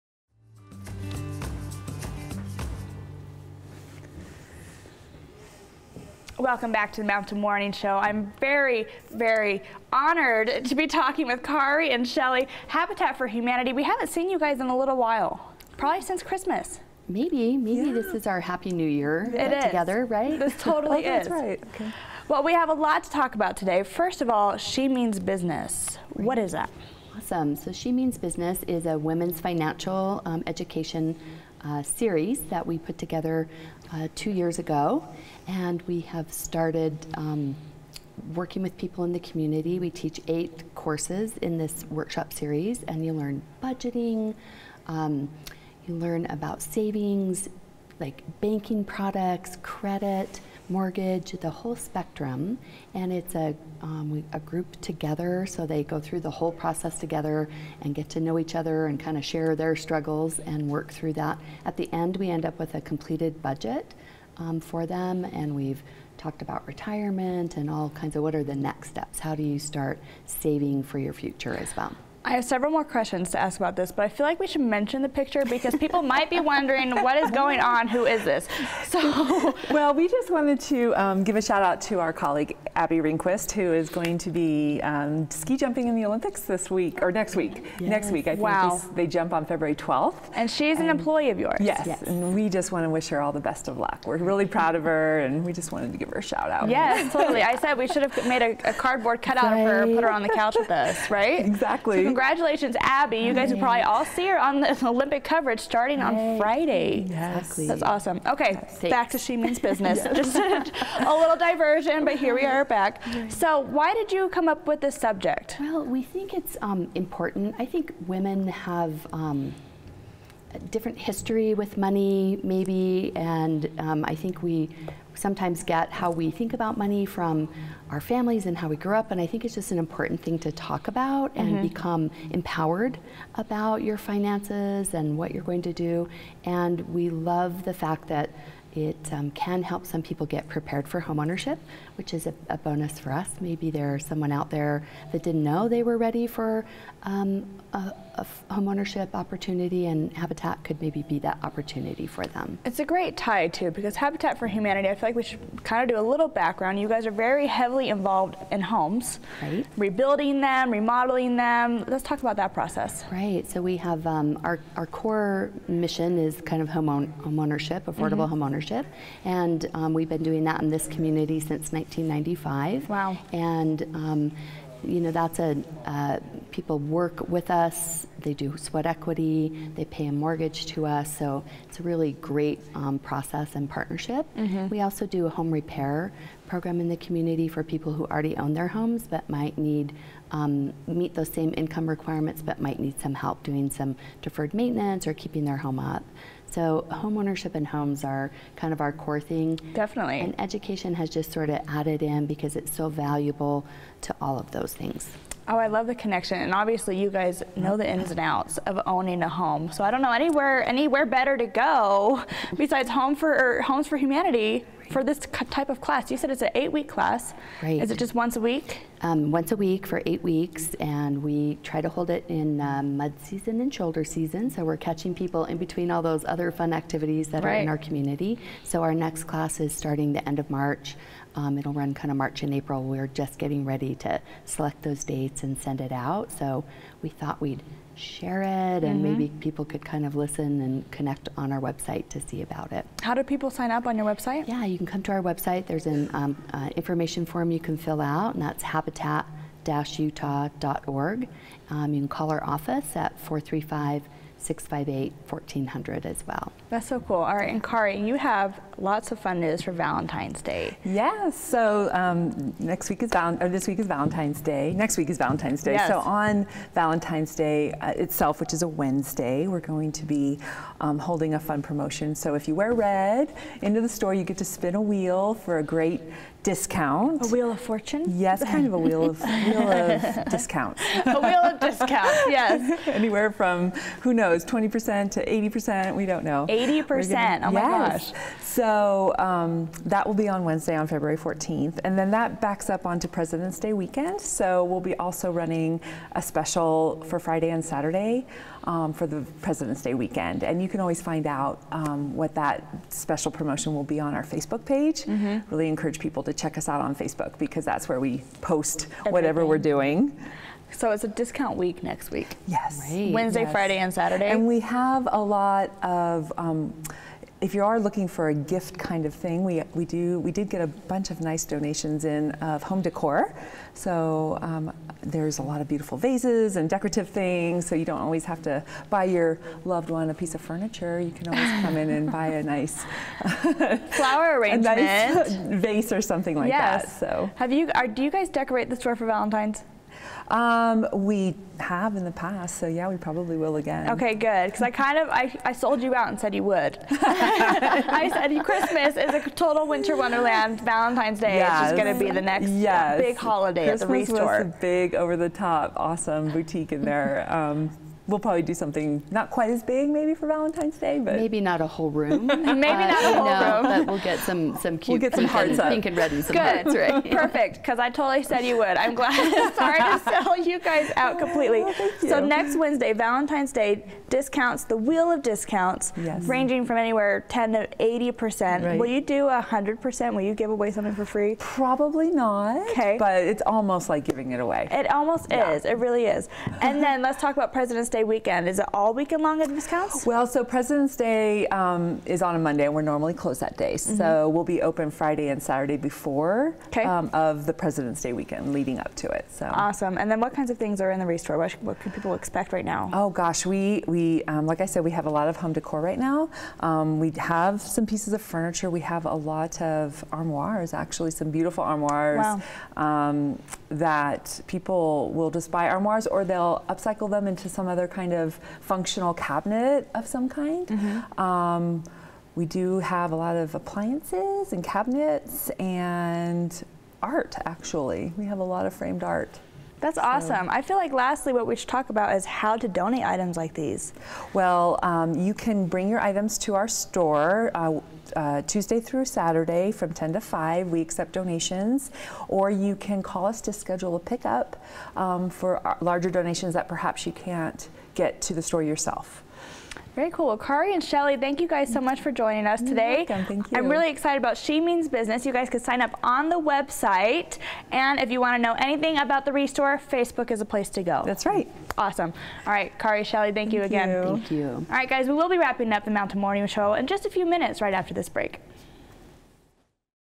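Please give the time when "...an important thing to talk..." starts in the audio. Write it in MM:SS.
02:09.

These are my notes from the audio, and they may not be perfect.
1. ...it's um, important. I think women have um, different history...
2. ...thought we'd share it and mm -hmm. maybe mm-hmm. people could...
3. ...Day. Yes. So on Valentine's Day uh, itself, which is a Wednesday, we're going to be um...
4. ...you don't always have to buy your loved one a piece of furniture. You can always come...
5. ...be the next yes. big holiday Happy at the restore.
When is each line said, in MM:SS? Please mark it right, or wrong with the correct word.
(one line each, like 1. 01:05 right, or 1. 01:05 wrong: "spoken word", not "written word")
1. 01:56 right
2. 03:57 right
3. 04:25 right
4. 05:27 right
5. 05:52 wrong: "Christmas", not "Happy".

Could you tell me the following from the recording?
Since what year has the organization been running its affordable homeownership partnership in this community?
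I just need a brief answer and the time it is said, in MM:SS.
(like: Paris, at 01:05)
1995, at 02:51.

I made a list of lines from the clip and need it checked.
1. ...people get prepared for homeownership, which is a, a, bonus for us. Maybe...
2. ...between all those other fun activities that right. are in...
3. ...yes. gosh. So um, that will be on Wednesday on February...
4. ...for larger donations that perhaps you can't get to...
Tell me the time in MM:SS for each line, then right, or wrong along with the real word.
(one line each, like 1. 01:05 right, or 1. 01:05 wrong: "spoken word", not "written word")
1. 02:20 right
2. 03:45 right
3. 04:47 right
4. 07:25 right.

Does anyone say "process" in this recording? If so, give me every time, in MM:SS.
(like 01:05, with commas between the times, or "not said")
00:56, 02:42, 03:02.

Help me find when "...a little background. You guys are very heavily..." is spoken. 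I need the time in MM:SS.
02:36.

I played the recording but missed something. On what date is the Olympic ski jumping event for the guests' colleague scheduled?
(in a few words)
February 12th.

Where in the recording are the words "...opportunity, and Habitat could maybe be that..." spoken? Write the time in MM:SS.
02:29.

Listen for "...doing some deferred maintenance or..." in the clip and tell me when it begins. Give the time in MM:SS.
03:13.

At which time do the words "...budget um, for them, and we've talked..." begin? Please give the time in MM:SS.
01:03.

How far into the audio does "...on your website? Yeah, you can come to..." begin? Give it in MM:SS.
04:03.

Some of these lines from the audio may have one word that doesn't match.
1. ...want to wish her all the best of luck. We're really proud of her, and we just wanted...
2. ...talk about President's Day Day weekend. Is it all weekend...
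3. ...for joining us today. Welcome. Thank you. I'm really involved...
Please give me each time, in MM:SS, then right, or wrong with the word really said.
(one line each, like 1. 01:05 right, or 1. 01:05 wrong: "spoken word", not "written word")
1. 01:32 right
2. 06:27 right
3. 07:31 wrong: "excited", not "involved".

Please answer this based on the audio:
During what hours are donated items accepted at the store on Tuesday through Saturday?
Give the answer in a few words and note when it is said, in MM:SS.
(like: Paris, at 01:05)
10 to 5, at 07:19.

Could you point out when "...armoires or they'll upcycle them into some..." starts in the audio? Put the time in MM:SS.
06:55.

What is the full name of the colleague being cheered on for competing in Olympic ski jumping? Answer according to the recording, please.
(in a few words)
Abby Ringquist.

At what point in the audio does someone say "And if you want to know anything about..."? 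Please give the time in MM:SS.
07:37.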